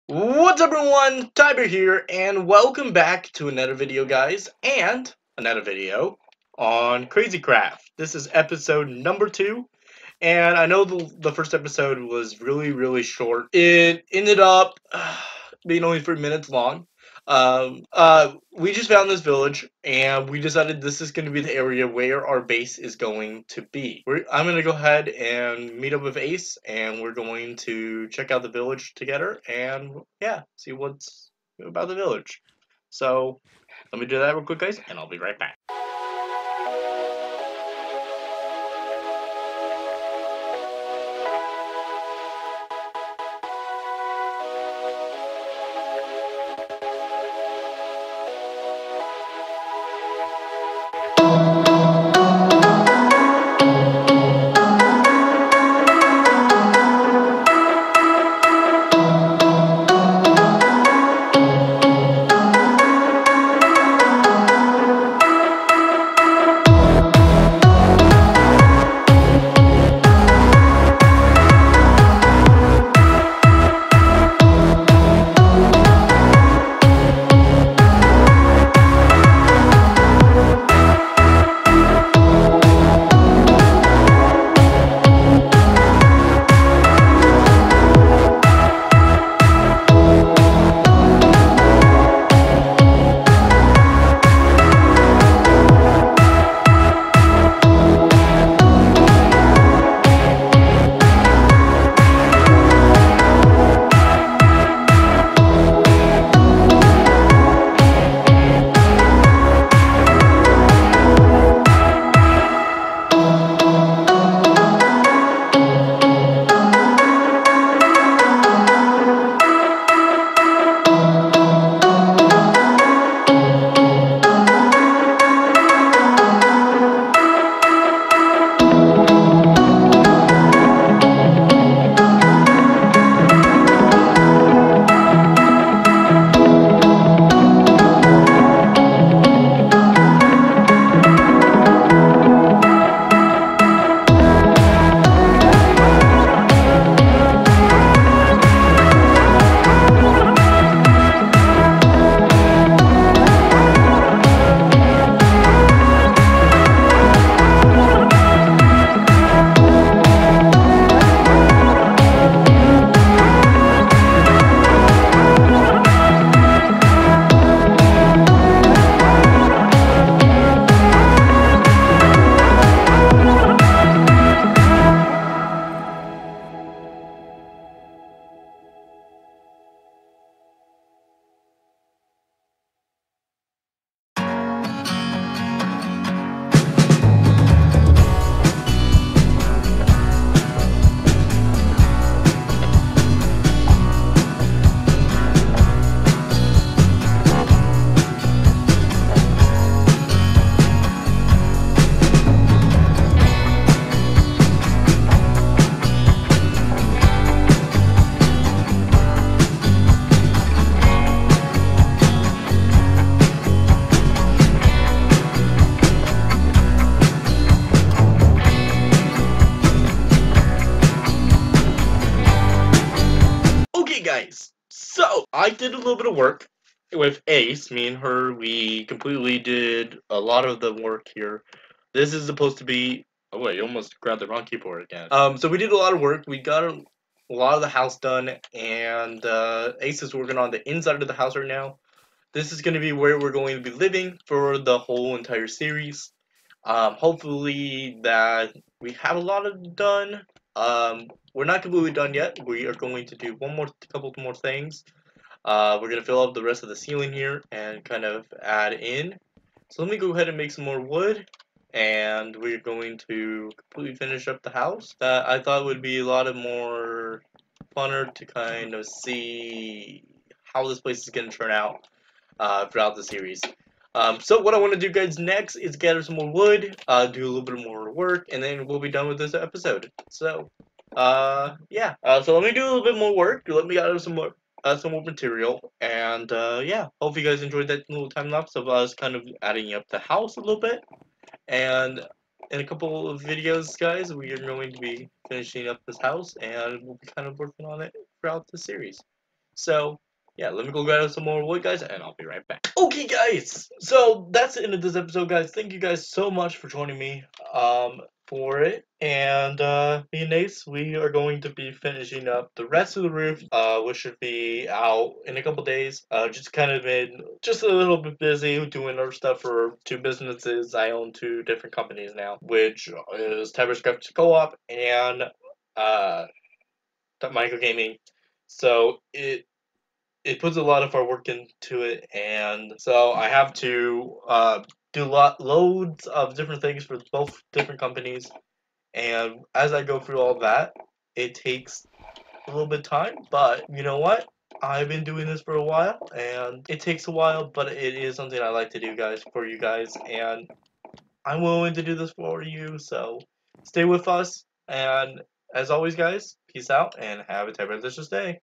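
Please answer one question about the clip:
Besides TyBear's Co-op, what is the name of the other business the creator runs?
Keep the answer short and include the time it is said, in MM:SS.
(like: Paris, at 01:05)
Mine Co Gaming, at 05:27.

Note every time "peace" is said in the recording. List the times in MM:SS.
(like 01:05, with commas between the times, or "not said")
05:56.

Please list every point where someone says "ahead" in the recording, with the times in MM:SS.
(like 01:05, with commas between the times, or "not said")
00:24, 04:20.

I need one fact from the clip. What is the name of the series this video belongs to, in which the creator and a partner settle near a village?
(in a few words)
CrazyCraft.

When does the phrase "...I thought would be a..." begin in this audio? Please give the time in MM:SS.
04:25.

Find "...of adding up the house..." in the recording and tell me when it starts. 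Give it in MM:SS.
04:49.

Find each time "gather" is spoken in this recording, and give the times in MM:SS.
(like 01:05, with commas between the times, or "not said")
04:35, 04:43.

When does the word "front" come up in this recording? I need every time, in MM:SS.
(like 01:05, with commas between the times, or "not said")
not said.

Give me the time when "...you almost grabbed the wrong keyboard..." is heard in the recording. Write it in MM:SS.
03:53.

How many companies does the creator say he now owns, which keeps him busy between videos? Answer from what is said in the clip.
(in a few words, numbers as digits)
2.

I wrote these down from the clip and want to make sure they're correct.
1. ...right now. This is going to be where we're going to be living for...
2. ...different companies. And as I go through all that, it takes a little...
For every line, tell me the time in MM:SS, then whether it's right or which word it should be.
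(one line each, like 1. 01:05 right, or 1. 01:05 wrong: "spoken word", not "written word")
1. 04:01 right
2. 05:37 right.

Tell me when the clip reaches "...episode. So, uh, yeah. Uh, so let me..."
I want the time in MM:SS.
04:39.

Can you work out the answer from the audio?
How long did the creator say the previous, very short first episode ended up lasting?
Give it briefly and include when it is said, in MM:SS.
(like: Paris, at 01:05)
3 minutes, at 00:15.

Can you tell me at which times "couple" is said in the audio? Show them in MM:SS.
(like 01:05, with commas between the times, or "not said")
04:13, 04:52, 05:15.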